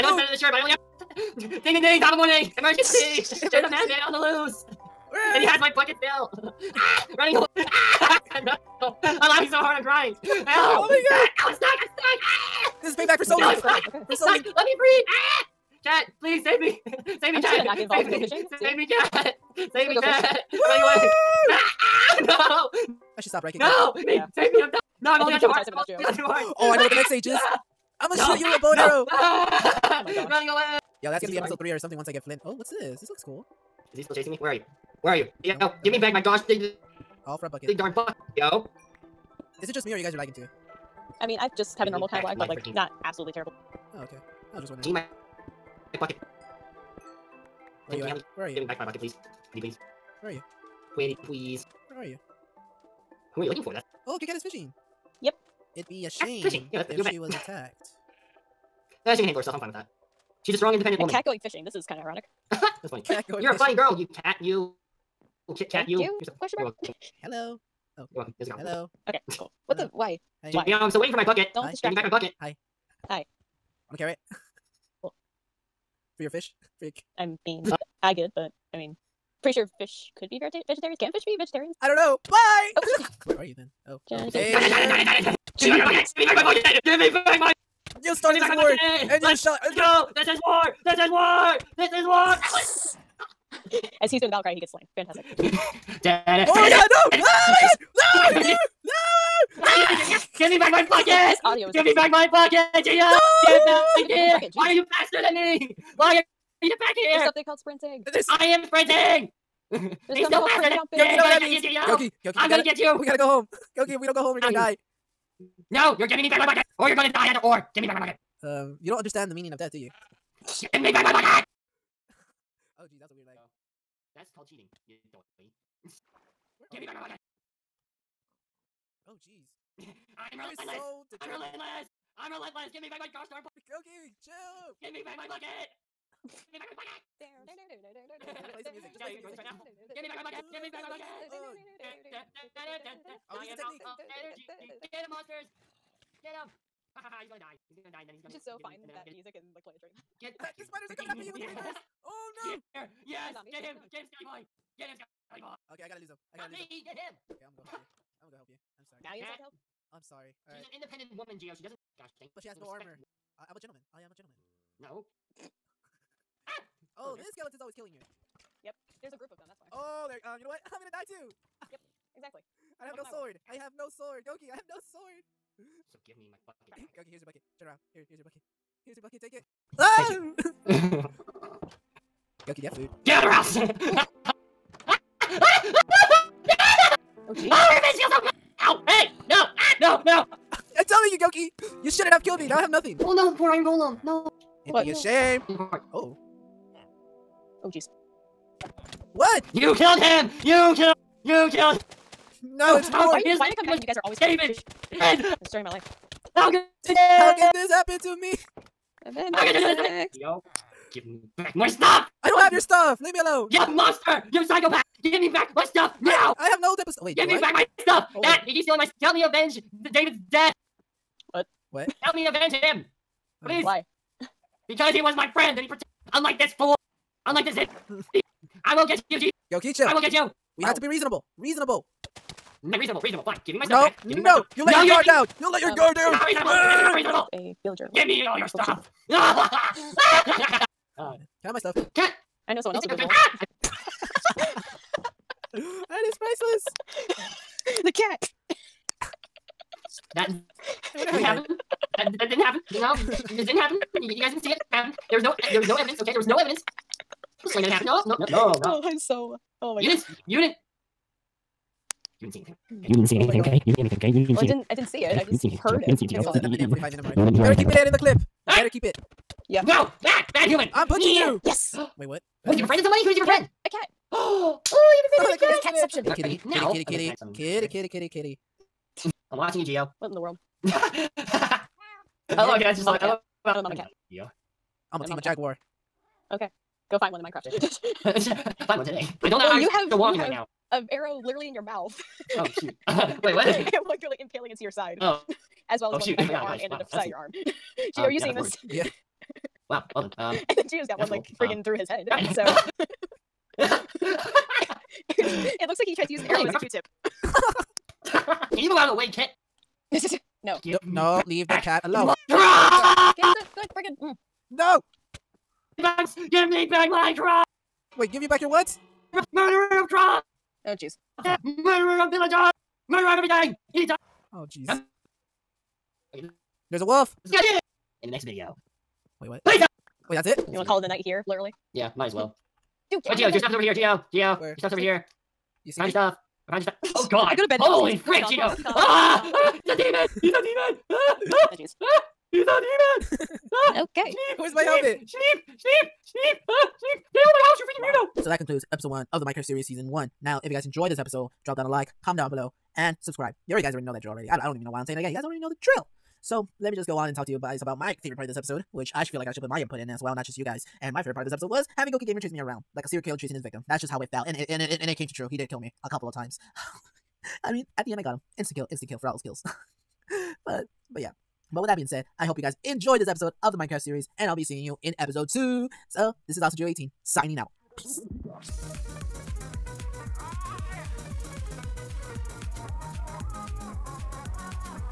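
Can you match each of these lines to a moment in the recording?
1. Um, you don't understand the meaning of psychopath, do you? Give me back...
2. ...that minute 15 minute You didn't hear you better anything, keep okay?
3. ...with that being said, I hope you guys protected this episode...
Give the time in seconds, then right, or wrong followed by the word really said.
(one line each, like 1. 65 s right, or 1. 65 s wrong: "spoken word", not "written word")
1. 118 s wrong: "death", not "psychopath"
2. 266 s wrong: "45", not "15"
3. 371 s wrong: "enjoyed", not "protected".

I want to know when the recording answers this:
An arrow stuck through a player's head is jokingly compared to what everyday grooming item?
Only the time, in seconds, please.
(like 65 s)
306 s.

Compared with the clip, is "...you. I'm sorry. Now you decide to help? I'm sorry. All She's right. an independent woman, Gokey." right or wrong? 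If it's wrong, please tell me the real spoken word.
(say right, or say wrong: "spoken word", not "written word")
wrong: "Geo", not "Gokey".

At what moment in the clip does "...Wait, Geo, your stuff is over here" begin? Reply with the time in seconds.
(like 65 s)
333 s.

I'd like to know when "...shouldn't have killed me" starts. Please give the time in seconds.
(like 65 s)
191 s.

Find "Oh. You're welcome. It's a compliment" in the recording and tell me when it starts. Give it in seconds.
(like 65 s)
67 s.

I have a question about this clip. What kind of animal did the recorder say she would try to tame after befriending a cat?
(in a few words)
A jaguar.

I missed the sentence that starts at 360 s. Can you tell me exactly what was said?
And my favorite part of this episode was having Gokey Gamer chase me around like a serial killer chasing his victim.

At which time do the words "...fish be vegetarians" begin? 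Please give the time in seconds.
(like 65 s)
81 s.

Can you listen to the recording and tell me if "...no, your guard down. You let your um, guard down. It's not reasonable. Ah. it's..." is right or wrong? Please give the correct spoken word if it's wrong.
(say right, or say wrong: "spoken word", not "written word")
right.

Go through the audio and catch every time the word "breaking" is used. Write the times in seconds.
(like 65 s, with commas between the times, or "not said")
23 s.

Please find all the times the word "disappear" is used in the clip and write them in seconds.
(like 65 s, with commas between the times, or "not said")
not said.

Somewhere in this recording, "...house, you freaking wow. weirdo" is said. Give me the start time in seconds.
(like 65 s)
347 s.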